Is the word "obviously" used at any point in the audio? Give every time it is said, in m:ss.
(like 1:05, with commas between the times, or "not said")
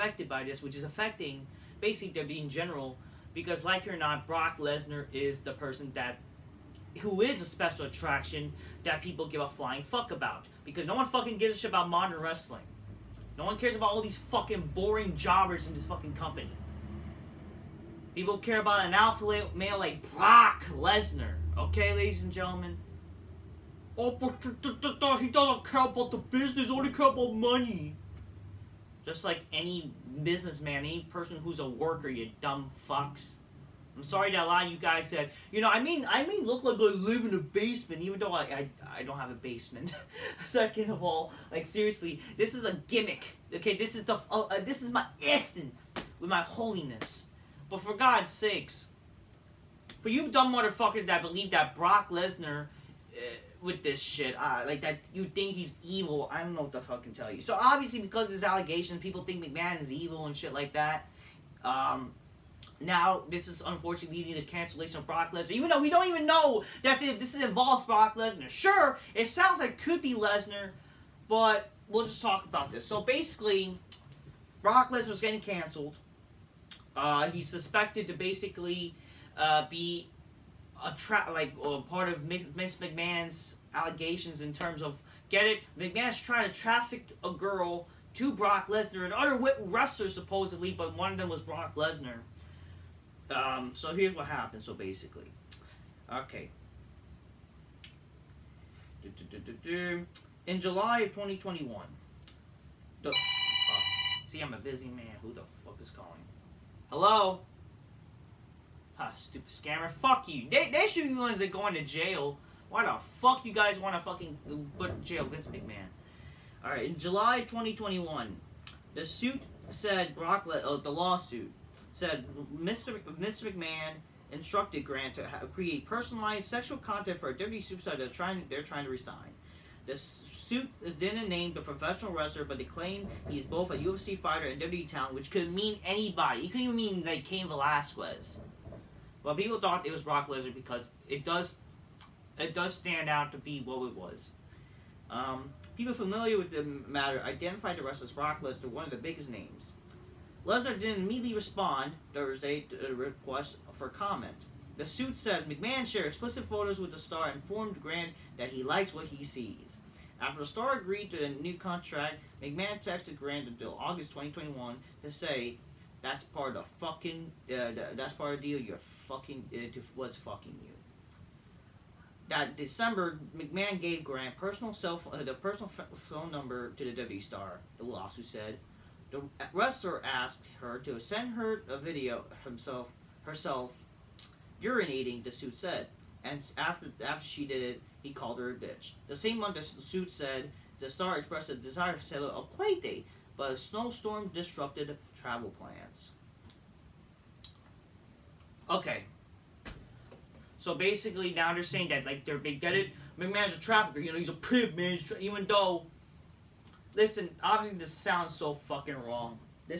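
0:57, 3:27.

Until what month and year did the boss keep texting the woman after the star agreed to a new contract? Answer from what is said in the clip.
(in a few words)
August 2021.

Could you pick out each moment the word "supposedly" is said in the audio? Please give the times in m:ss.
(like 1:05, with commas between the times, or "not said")
1:30.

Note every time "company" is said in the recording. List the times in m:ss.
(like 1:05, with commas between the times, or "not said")
0:16.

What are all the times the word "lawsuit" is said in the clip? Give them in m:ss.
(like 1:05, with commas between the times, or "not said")
2:00, 2:57.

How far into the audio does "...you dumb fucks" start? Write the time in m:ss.
0:32.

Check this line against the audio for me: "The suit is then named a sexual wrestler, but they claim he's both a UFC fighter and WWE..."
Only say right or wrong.
wrong.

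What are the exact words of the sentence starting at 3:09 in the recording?
The same month, the suit said the star expressed a desire to settle a play date, but a snowstorm disrupted travel plans.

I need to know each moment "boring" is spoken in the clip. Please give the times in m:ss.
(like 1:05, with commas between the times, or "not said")
0:14.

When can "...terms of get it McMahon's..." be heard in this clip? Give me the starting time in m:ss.
1:24.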